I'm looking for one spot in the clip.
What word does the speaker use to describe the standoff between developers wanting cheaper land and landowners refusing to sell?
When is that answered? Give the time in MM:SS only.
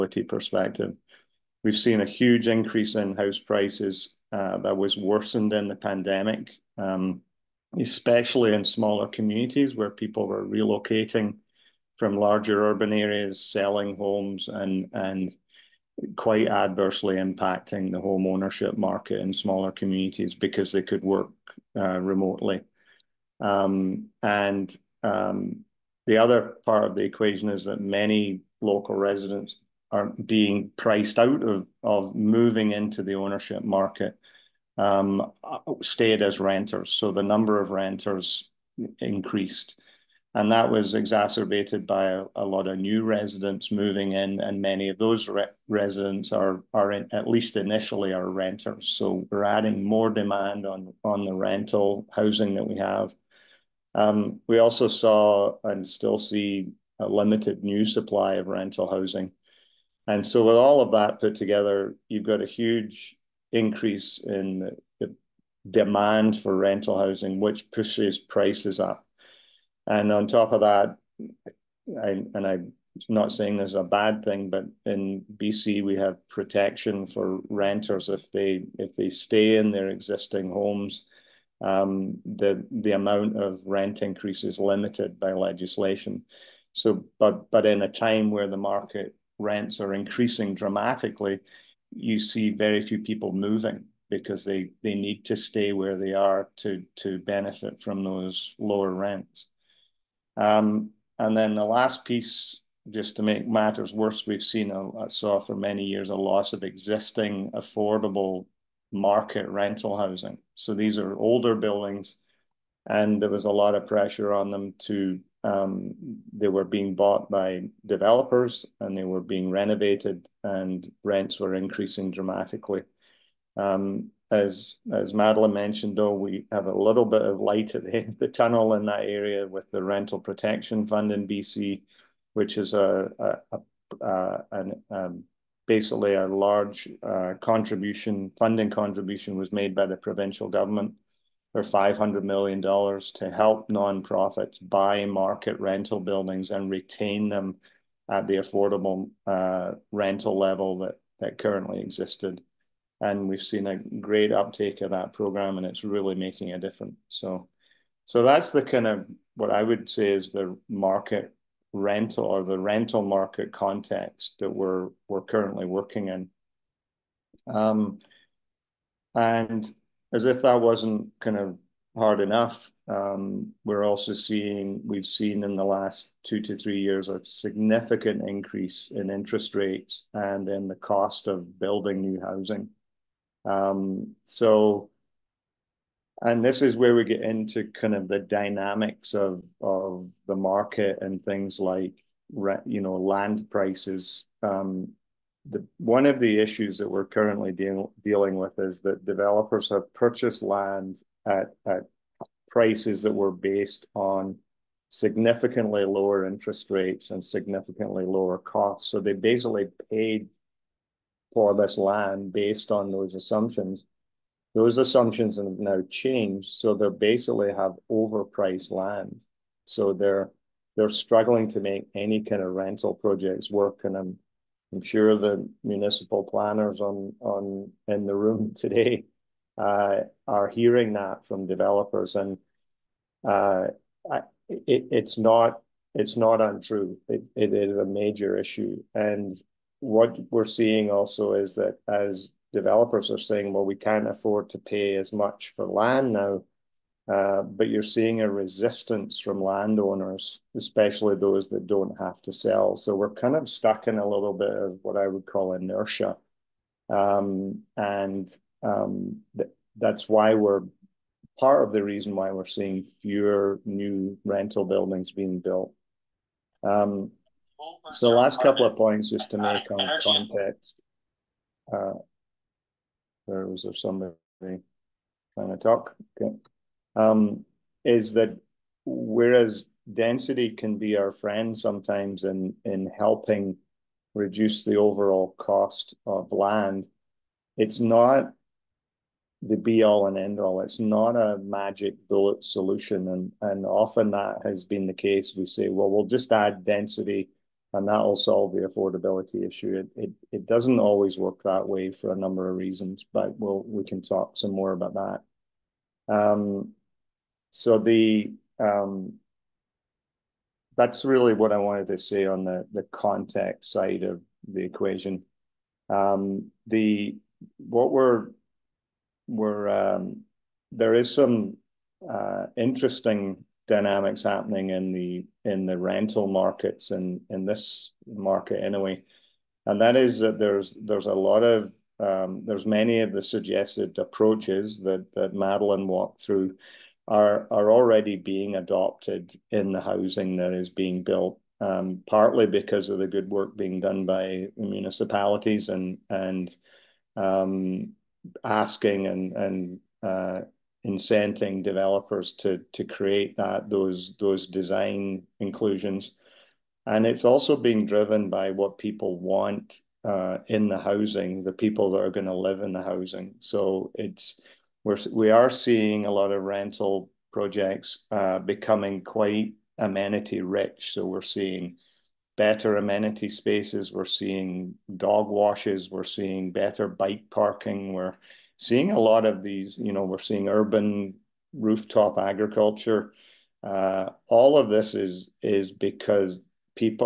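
04:15.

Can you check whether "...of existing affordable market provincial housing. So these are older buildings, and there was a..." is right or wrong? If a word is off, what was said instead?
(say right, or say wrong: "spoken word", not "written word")
wrong: "rental", not "provincial".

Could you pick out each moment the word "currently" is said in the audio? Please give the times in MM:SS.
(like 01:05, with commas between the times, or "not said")
02:31, 02:45, 03:17.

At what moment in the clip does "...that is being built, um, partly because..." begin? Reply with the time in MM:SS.
05:40.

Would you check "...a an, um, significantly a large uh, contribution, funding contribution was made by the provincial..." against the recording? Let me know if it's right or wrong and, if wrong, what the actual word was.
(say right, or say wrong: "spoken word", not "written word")
wrong: "basically", not "significantly".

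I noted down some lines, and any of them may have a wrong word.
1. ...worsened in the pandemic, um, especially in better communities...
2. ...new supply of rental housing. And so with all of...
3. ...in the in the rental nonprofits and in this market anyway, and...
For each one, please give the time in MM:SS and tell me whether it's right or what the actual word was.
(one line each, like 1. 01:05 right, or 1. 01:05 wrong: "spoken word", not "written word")
1. 00:04 wrong: "smaller", not "better"
2. 00:57 right
3. 05:24 wrong: "markets", not "nonprofits".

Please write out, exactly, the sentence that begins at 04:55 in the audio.
We say, well, we'll just add density and that'll solve the affordability issue.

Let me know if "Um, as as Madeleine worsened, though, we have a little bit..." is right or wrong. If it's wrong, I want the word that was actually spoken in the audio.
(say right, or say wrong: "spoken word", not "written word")
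wrong: "mentioned", not "worsened".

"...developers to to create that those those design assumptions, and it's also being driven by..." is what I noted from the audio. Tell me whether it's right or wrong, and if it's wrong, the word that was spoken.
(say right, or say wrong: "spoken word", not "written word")
wrong: "inclusions", not "assumptions".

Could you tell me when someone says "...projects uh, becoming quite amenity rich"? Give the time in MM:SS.
06:07.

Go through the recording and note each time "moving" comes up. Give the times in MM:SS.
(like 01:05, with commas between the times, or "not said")
00:32, 00:43, 01:33.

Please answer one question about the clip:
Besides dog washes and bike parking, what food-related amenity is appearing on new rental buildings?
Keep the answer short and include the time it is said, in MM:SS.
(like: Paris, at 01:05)
urban rooftop agriculture, at 06:20.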